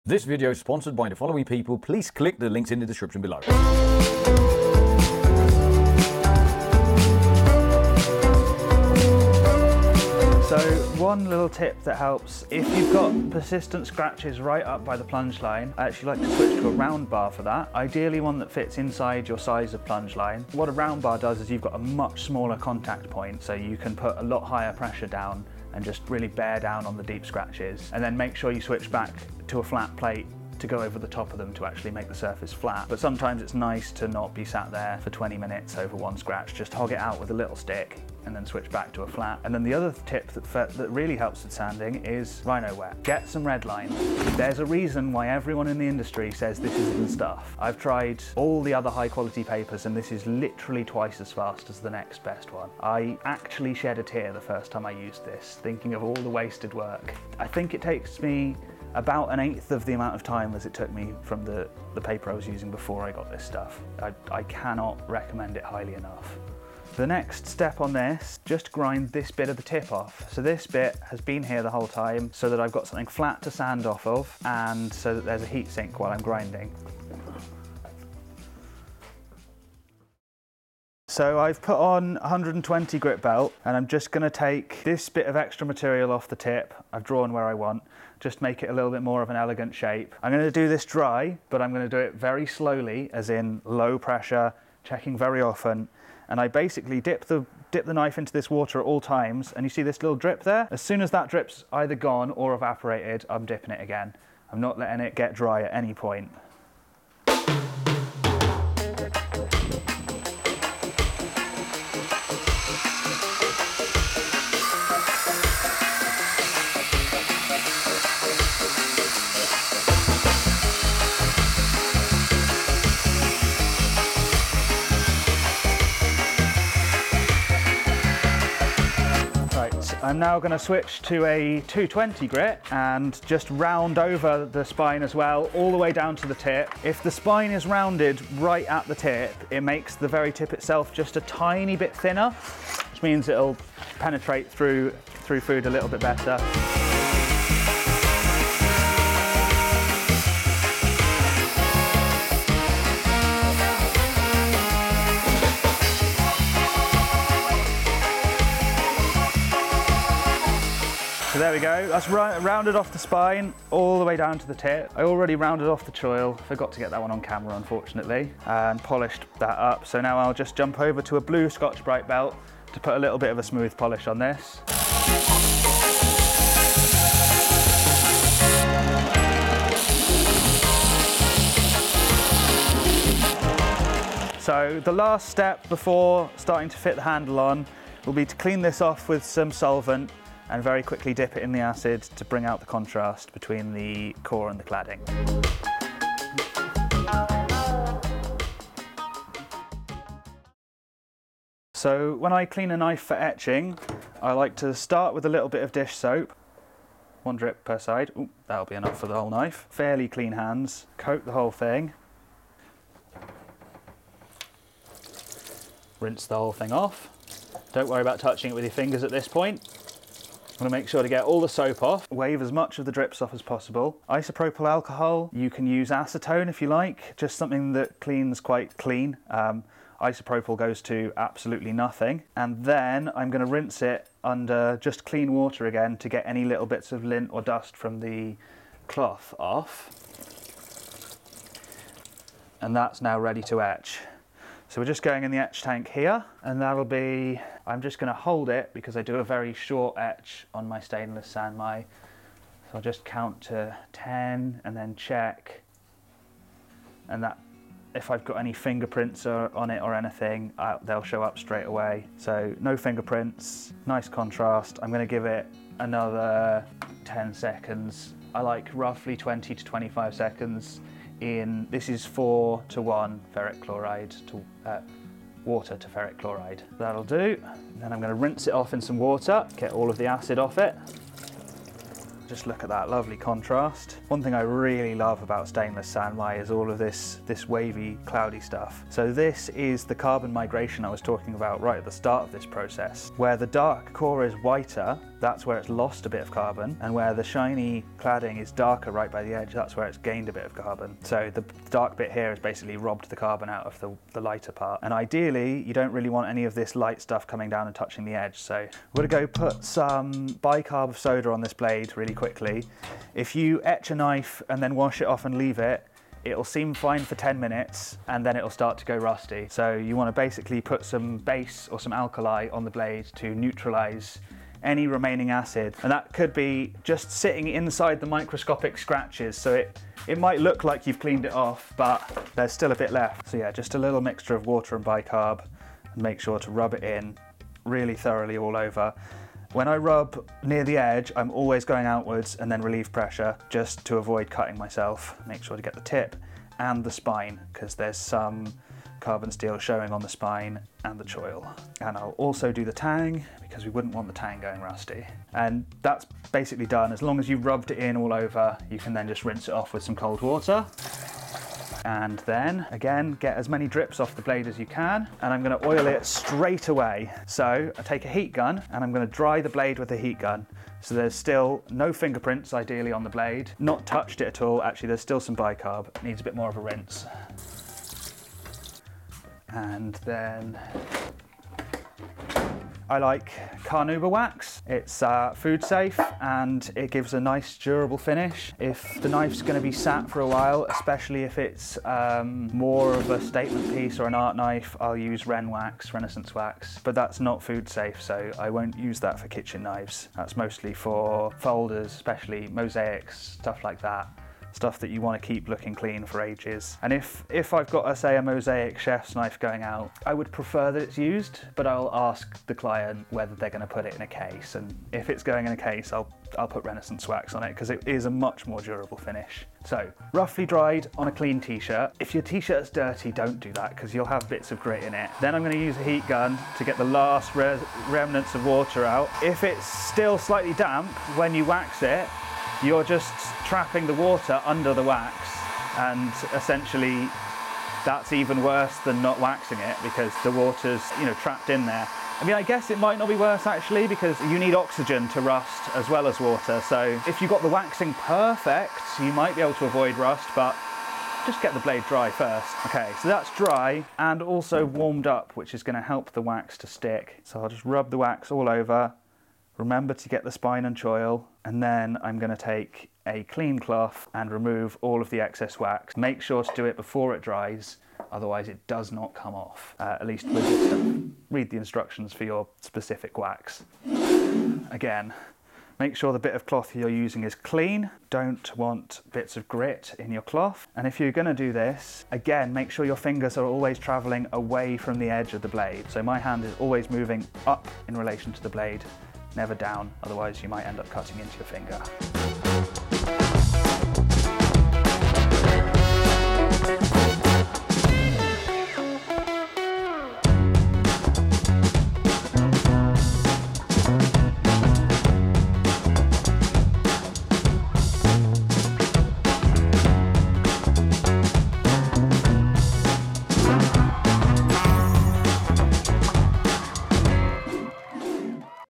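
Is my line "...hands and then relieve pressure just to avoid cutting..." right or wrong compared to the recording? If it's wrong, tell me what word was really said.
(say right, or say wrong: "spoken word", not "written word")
wrong: "outwards", not "hands".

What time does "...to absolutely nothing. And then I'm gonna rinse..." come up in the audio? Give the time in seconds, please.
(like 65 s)
230 s.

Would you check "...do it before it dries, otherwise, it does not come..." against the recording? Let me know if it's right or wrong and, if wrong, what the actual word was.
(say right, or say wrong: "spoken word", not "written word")
right.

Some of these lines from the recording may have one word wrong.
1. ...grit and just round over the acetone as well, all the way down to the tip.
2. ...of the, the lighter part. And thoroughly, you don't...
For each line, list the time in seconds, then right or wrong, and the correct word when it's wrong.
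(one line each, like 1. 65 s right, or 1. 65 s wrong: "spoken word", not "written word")
1. 132 s wrong: "spine", not "acetone"
2. 303 s wrong: "ideally", not "thoroughly".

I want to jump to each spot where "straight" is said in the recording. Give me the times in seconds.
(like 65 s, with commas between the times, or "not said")
261 s, 366 s.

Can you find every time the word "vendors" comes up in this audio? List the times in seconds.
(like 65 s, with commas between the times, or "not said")
not said.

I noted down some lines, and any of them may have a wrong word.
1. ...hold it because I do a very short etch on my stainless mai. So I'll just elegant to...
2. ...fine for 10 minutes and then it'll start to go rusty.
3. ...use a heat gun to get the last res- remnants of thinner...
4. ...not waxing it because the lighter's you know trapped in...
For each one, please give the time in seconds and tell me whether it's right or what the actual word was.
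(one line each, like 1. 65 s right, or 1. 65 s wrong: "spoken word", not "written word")
1. 248 s wrong: "count", not "elegant"
2. 316 s right
3. 425 s wrong: "water", not "thinner"
4. 439 s wrong: "water", not "lighter".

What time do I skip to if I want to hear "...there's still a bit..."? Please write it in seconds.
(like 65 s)
332 s.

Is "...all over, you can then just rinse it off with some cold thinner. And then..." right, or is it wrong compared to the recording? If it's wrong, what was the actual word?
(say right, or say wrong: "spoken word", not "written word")
wrong: "water", not "thinner".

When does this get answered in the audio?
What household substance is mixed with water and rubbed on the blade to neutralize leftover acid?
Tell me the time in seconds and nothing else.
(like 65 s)
310 s.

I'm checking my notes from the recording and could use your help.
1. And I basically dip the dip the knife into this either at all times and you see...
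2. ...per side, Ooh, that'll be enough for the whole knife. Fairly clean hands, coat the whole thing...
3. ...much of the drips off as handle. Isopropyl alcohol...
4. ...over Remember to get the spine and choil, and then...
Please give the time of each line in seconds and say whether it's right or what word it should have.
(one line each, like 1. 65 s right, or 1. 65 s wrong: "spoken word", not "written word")
1. 96 s wrong: "water", not "either"
2. 207 s right
3. 222 s wrong: "possible", not "handle"
4. 458 s right.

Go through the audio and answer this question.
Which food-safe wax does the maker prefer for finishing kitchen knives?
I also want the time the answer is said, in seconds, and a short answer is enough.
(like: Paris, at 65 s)
Carnauba wax, at 383 s.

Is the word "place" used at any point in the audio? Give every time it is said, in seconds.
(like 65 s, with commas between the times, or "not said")
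not said.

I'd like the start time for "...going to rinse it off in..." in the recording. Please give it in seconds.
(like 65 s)
278 s.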